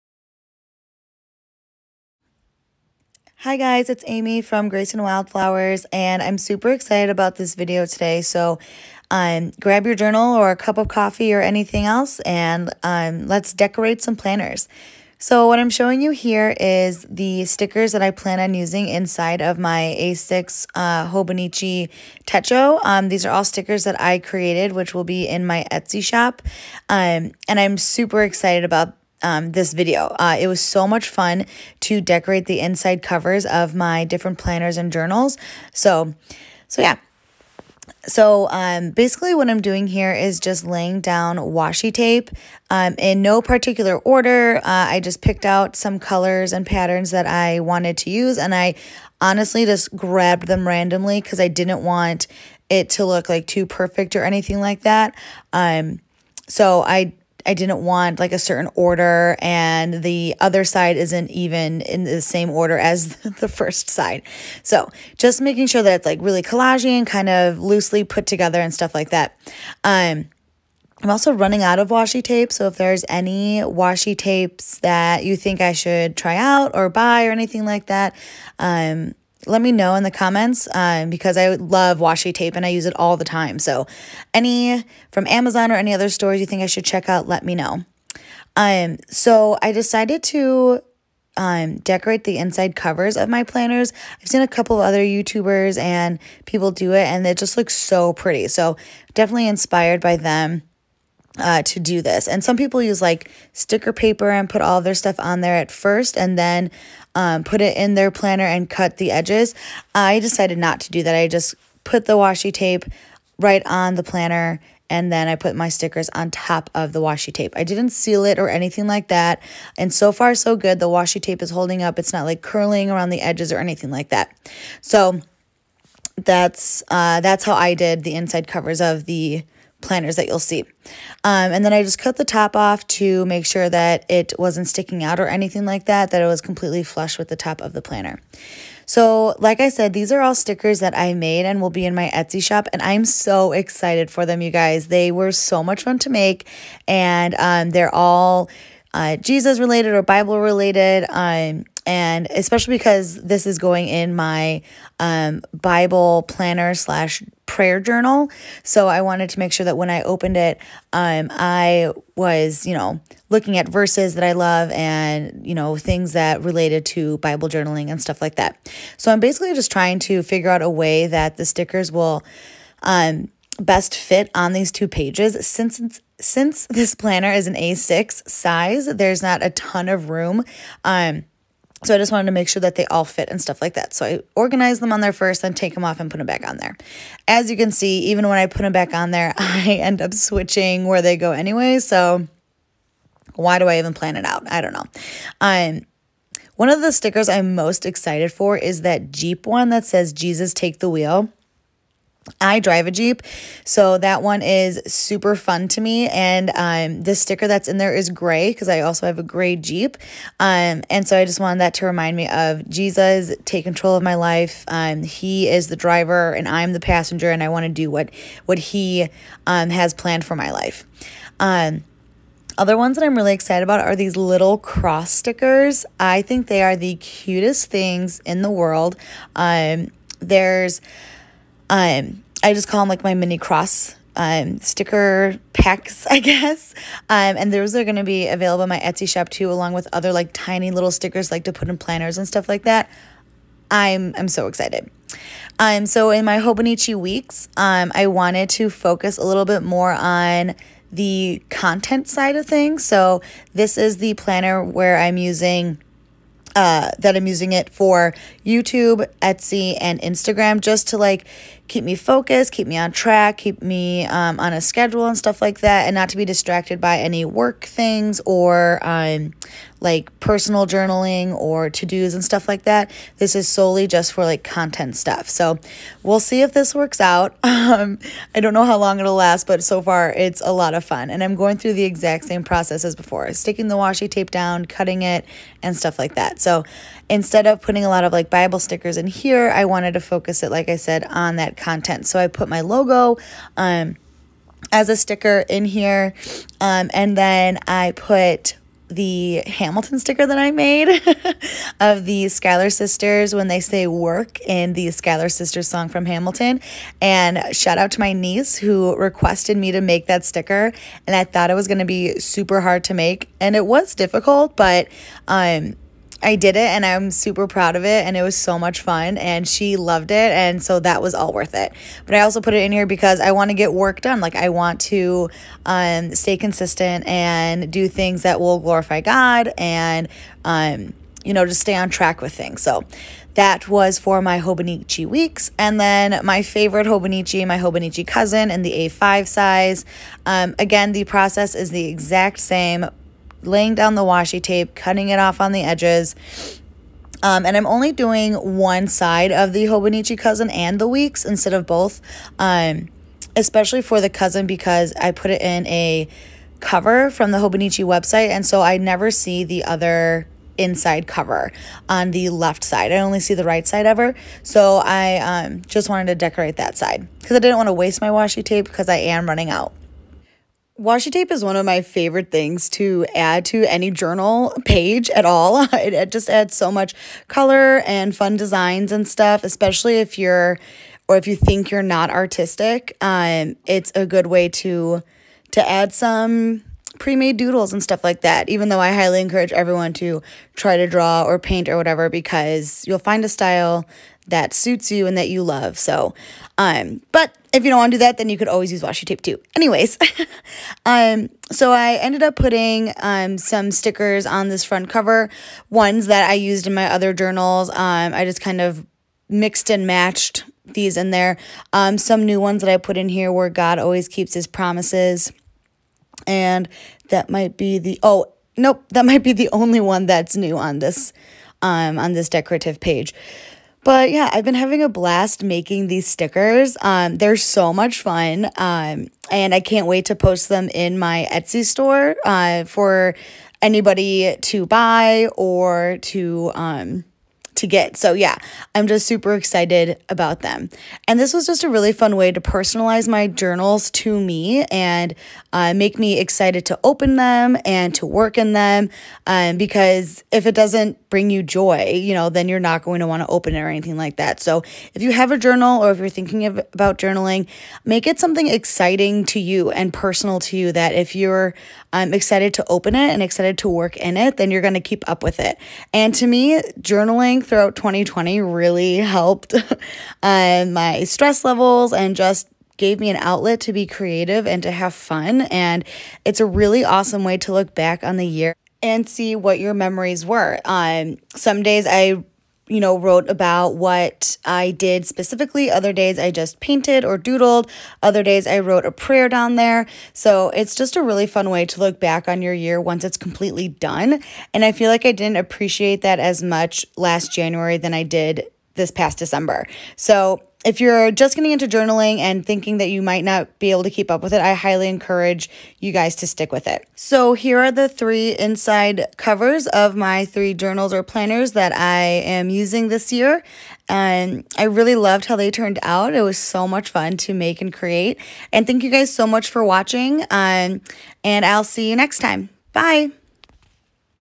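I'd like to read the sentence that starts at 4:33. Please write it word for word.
This is solely just for like content stuff.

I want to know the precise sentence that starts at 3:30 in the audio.
Um, and so I just wanted that to remind me of Jesus, take control of my life.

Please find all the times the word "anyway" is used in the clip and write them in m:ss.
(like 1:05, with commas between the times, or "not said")
3:11, 6:39.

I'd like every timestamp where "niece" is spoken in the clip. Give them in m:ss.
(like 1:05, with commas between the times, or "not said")
5:08.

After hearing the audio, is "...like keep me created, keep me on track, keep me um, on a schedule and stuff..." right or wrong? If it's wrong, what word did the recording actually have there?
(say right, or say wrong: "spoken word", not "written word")
wrong: "focused", not "created".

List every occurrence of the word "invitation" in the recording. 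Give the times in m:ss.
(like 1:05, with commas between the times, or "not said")
not said.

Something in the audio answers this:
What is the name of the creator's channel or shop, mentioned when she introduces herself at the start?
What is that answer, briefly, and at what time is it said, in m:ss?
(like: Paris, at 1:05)
Grace and Wildflowers, at 0:04.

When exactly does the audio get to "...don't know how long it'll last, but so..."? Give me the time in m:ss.
4:38.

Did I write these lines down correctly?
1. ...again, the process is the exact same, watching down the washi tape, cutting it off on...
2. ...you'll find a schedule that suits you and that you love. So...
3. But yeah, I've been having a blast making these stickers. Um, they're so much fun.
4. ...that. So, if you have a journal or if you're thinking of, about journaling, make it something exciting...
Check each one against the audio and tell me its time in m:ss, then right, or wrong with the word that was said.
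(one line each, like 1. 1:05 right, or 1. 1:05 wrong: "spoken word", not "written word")
1. 5:40 wrong: "laying", not "watching"
2. 6:32 wrong: "style", not "schedule"
3. 7:03 right
4. 7:34 right.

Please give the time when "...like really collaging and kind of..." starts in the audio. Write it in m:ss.
1:06.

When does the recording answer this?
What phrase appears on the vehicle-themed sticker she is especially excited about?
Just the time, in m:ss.
3:20.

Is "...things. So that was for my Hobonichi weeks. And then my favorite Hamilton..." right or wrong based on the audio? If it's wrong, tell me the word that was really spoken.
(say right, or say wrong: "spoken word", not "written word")
wrong: "Hobonichi", not "Hamilton".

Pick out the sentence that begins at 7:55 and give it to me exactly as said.
And it's a really awesome way to look back on the year and see what your memories were.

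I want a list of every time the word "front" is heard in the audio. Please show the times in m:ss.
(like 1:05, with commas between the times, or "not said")
6:44.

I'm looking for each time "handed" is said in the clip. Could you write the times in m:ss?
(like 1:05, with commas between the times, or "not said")
not said.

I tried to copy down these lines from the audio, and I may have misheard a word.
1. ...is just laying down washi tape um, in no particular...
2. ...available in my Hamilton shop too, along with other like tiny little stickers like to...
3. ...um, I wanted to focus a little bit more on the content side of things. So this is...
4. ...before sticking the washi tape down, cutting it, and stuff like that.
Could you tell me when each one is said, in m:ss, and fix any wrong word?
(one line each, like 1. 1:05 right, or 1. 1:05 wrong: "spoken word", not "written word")
1. 0:40 right
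2. 3:58 wrong: "Etsy", not "Hamilton"
3. 4:07 right
4. 4:42 right.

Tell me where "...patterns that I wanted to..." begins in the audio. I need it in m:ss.
0:46.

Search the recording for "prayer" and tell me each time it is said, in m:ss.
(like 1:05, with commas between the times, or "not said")
2:37, 8:08.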